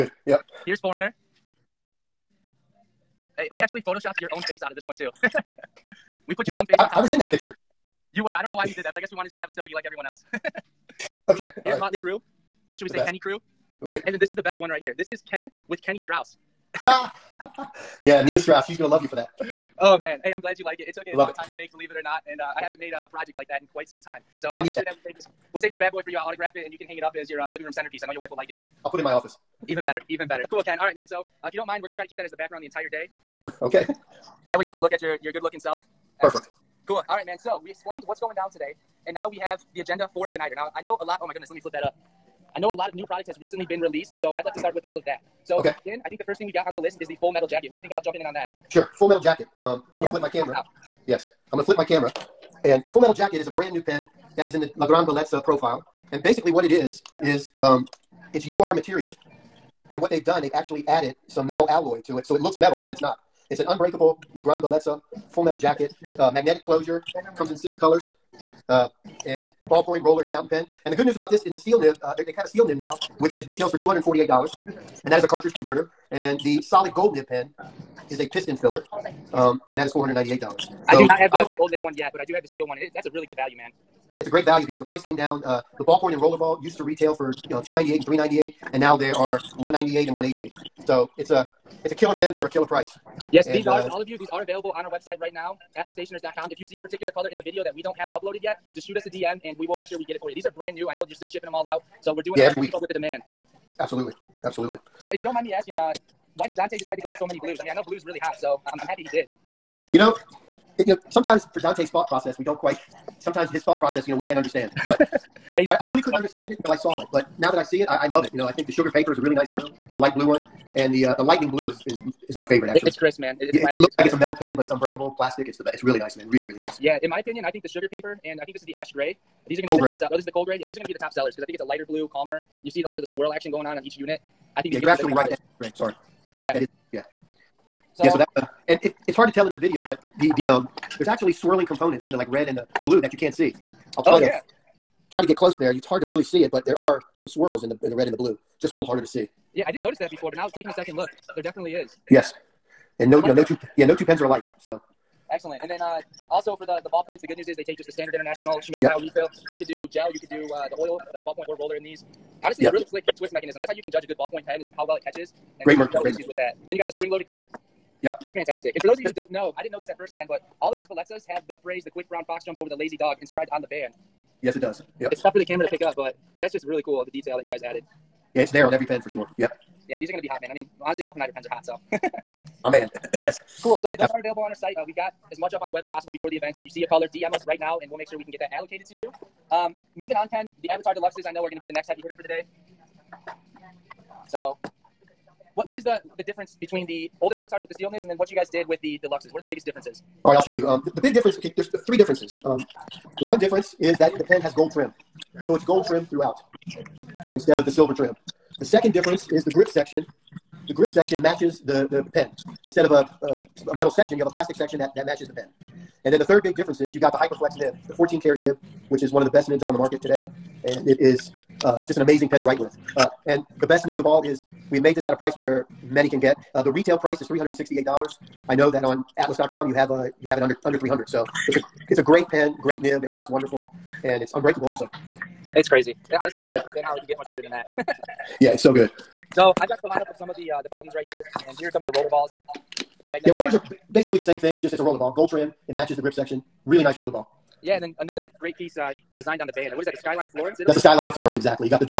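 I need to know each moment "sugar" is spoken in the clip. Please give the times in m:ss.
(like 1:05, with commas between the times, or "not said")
1:58, 2:07.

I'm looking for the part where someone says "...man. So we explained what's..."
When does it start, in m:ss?
0:37.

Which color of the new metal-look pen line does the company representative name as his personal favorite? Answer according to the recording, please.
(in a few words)
lightning blue.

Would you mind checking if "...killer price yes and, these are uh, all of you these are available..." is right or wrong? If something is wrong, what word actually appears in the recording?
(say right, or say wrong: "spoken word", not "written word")
right.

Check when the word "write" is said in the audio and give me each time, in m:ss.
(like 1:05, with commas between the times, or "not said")
3:42, 3:53.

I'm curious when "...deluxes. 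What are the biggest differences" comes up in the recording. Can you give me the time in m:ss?
3:19.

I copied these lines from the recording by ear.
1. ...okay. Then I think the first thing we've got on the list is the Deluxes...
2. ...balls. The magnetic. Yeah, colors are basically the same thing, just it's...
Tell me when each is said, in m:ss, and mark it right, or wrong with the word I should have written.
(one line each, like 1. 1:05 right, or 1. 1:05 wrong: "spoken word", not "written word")
1. 0:45 wrong: "Full", not "Deluxes"
2. 4:02 wrong: "rollers", not "colors".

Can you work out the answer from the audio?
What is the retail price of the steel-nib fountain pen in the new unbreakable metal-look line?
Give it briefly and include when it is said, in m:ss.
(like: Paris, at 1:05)
$248, at 1:13.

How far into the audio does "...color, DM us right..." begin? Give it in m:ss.
3:06.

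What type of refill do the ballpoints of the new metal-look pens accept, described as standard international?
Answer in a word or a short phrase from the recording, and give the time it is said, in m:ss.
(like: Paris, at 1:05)
Schmidt style, at 2:38.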